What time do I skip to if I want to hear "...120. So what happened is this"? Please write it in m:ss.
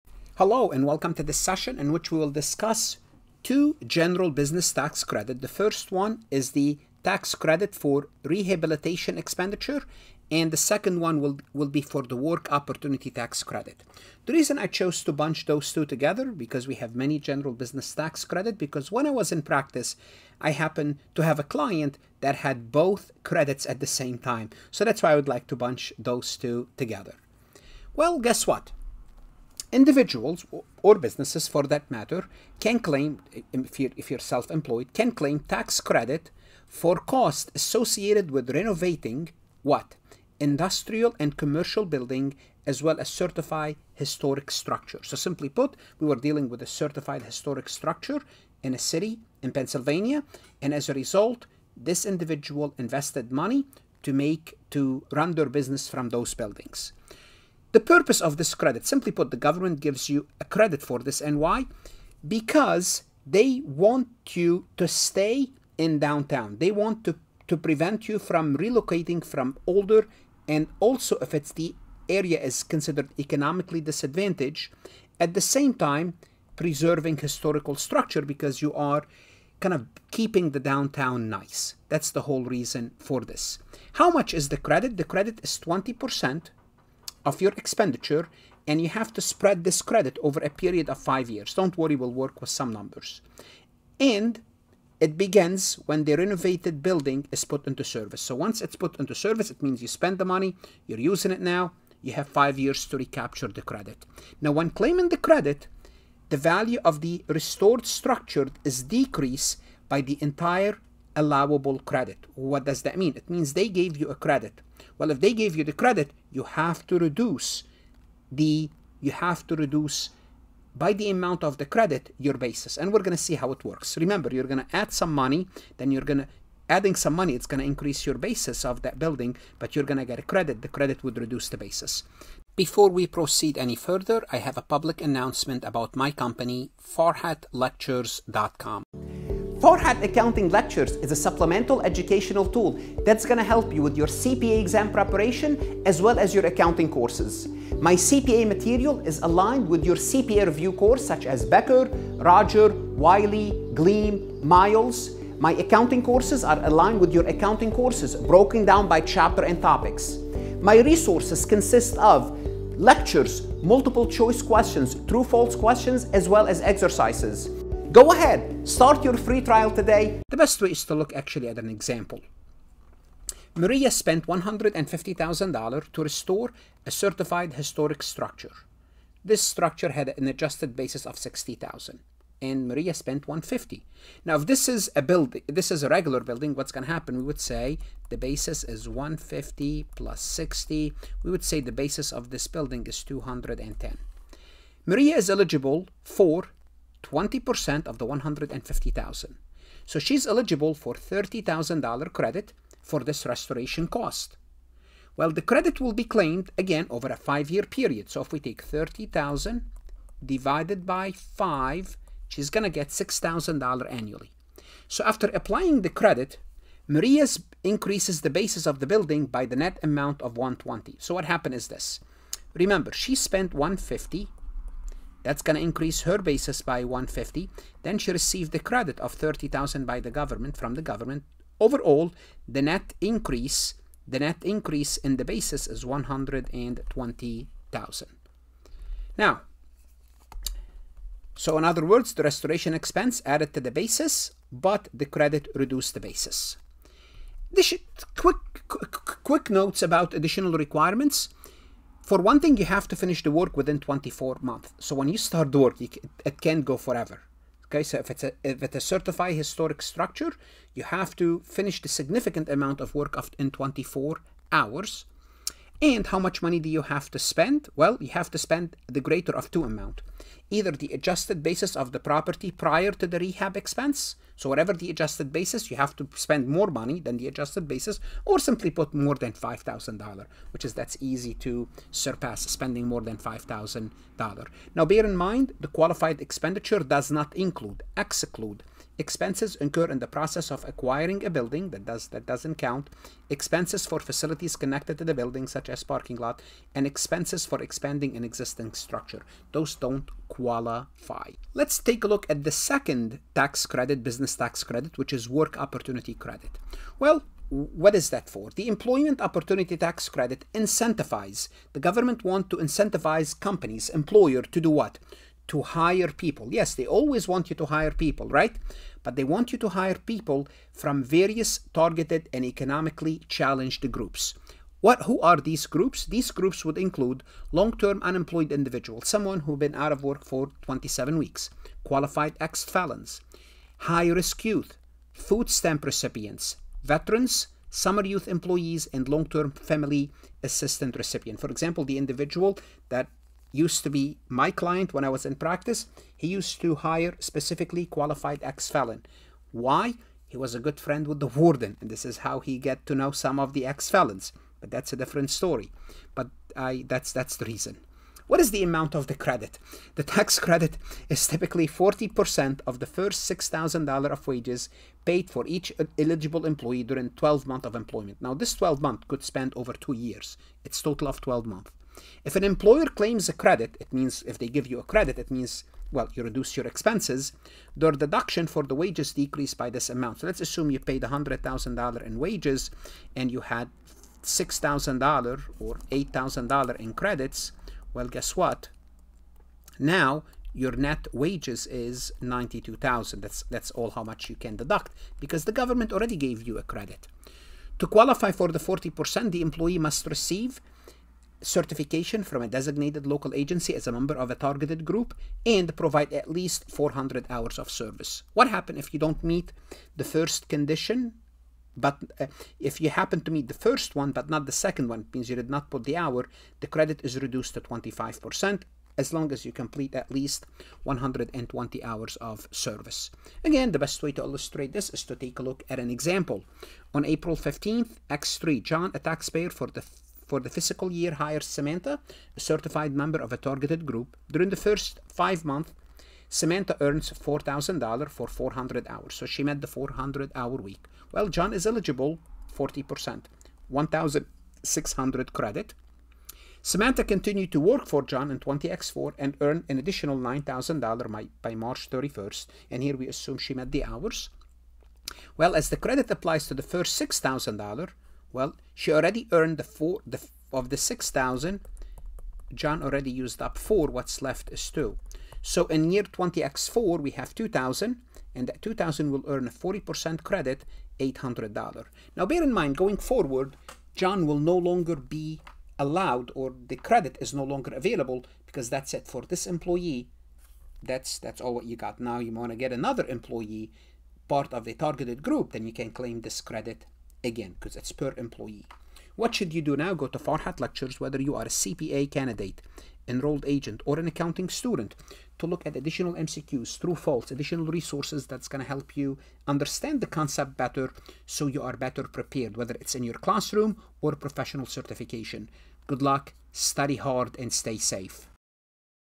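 3:40.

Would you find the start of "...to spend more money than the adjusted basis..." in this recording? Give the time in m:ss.
4:35.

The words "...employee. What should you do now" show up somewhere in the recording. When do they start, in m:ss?
8:08.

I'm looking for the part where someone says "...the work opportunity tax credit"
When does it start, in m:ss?
0:12.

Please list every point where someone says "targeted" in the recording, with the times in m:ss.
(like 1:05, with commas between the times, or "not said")
5:21, 6:44, 7:13, 8:04.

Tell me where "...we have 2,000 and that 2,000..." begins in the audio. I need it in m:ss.
7:46.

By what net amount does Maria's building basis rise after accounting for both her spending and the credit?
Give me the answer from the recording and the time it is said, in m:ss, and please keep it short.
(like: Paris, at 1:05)
$120,000, at 3:55.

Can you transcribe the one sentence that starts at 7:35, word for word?
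Well, as the credit applies to the first $6,000, well, she already earned the four the, of the 6,000.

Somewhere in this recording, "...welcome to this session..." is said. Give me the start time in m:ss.
0:00.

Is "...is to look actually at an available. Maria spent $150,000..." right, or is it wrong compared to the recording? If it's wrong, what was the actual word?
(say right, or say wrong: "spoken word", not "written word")
wrong: "example", not "available".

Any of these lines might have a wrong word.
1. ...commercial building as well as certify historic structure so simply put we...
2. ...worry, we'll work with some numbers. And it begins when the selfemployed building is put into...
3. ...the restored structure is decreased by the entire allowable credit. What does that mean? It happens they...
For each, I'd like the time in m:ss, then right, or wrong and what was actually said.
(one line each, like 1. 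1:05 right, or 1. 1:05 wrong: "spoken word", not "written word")
1. 0:41 right
2. 1:31 wrong: "renovated", not "selfemployed"
3. 1:47 wrong: "means", not "happens".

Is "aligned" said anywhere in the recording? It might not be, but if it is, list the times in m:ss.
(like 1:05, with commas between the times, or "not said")
2:29, 2:36.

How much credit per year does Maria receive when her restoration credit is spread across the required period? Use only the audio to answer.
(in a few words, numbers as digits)
$6,000.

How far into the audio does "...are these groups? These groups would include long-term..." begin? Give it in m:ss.
5:25.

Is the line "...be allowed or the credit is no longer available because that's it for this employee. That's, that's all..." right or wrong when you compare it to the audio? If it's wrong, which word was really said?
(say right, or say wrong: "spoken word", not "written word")
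right.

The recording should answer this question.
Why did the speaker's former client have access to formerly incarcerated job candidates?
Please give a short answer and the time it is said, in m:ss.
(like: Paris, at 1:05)
friend with the warden, at 5:50.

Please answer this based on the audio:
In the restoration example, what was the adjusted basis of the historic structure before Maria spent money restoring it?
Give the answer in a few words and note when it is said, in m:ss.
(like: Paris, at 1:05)
$60,000, at 3:01.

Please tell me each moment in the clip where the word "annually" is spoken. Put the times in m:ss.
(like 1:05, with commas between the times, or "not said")
3:33.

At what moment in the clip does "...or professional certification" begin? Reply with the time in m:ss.
8:24.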